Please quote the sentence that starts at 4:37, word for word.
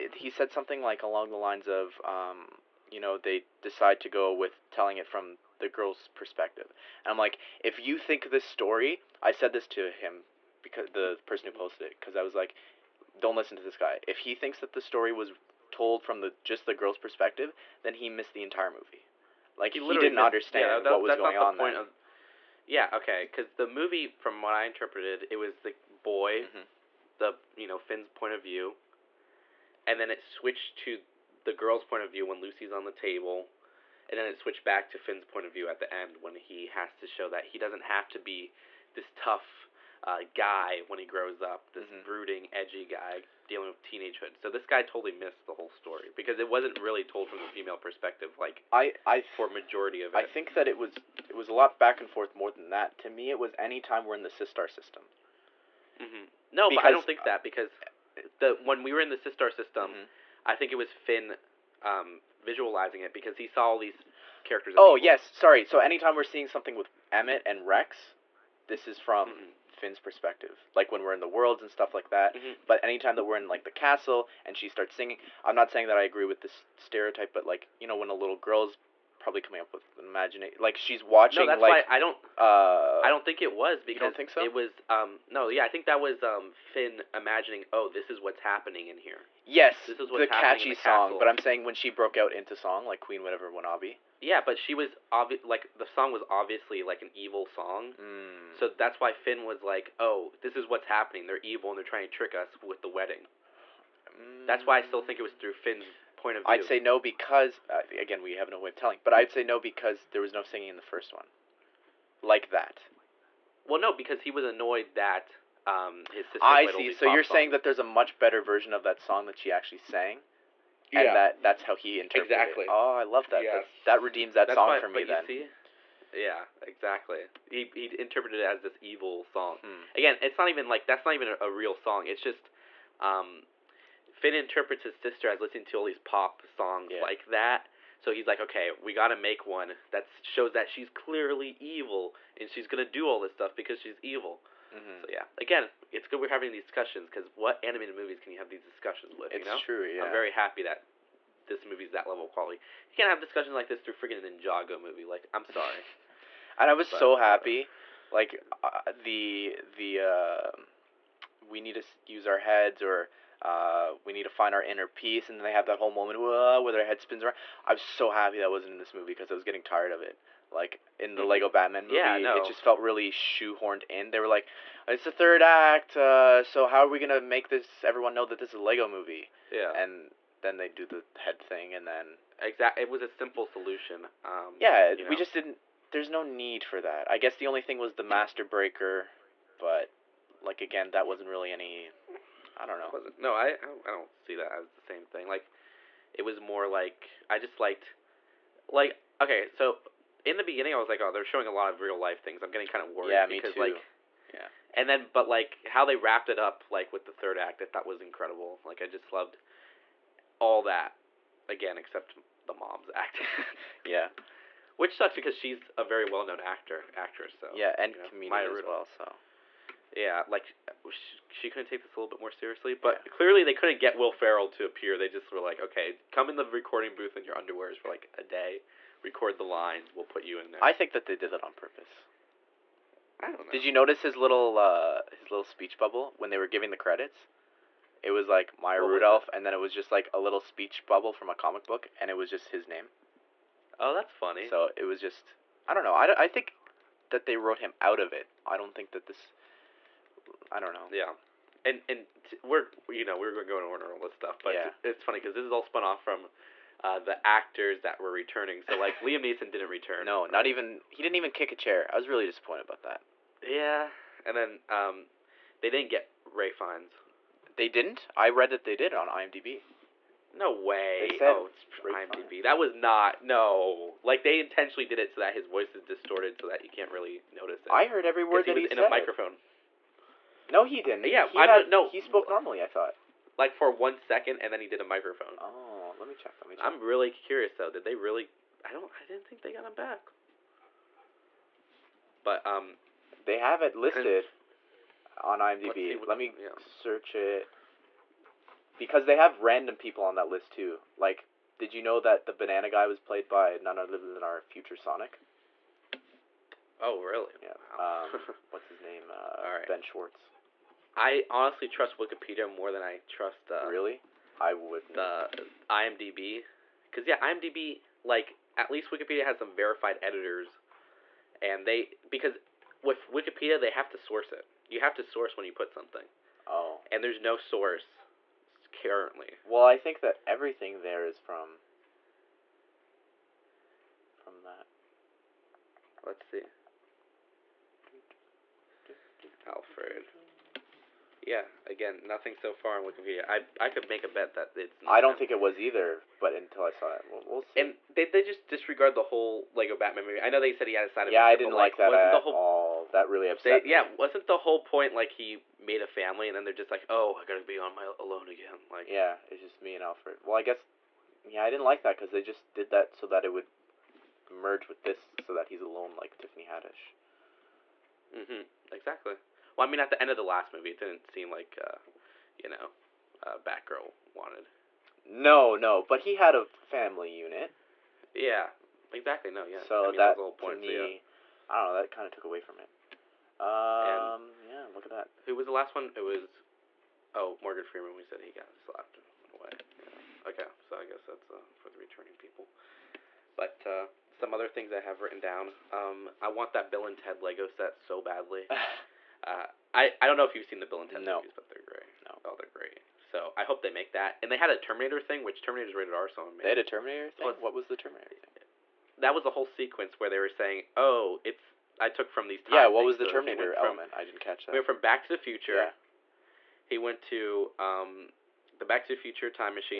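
I heard every word that he was he in said.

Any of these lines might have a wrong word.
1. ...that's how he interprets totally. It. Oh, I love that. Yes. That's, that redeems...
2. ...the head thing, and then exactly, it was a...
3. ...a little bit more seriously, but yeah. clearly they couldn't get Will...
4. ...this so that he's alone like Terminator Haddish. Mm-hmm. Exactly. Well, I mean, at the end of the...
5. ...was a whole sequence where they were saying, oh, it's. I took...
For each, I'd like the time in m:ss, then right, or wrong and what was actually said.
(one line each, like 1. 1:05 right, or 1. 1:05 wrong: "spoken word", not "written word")
1. 2:01 wrong: "exactly", not "totally"
2. 3:00 right
3. 3:41 right
4. 6:04 wrong: "Tiffany", not "Terminator"
5. 6:49 right.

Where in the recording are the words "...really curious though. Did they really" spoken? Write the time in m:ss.
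4:46.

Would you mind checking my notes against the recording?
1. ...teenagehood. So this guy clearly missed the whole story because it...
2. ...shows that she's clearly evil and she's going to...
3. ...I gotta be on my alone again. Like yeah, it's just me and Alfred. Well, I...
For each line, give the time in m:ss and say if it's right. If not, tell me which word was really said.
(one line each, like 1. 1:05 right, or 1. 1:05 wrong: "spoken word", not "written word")
1. 0:43 wrong: "totally", not "clearly"
2. 2:20 right
3. 5:57 right.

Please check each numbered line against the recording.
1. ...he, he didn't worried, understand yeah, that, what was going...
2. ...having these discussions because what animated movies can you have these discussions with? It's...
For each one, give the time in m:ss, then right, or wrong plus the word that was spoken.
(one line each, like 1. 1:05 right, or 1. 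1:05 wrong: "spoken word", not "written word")
1. 0:19 wrong: "missed", not "worried"
2. 2:26 right.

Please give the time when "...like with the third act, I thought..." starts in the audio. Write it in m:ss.
3:26.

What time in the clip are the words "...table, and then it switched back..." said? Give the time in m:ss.
0:32.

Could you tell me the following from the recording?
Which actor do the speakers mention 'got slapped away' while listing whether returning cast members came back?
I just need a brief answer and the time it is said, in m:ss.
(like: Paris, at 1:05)
Morgan Freeman, at 6:27.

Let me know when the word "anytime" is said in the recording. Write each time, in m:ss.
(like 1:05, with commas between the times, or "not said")
1:05, 1:12.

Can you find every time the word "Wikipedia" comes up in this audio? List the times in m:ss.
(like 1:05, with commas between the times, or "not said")
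5:11, 5:18, 5:23, 5:42.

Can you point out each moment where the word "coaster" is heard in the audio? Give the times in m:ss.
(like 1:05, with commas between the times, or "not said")
not said.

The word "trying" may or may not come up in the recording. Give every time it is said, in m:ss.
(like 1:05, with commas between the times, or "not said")
1:41.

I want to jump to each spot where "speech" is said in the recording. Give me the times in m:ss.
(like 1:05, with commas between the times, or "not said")
3:55, 4:00.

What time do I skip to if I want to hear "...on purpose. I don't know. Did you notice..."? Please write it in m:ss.
3:51.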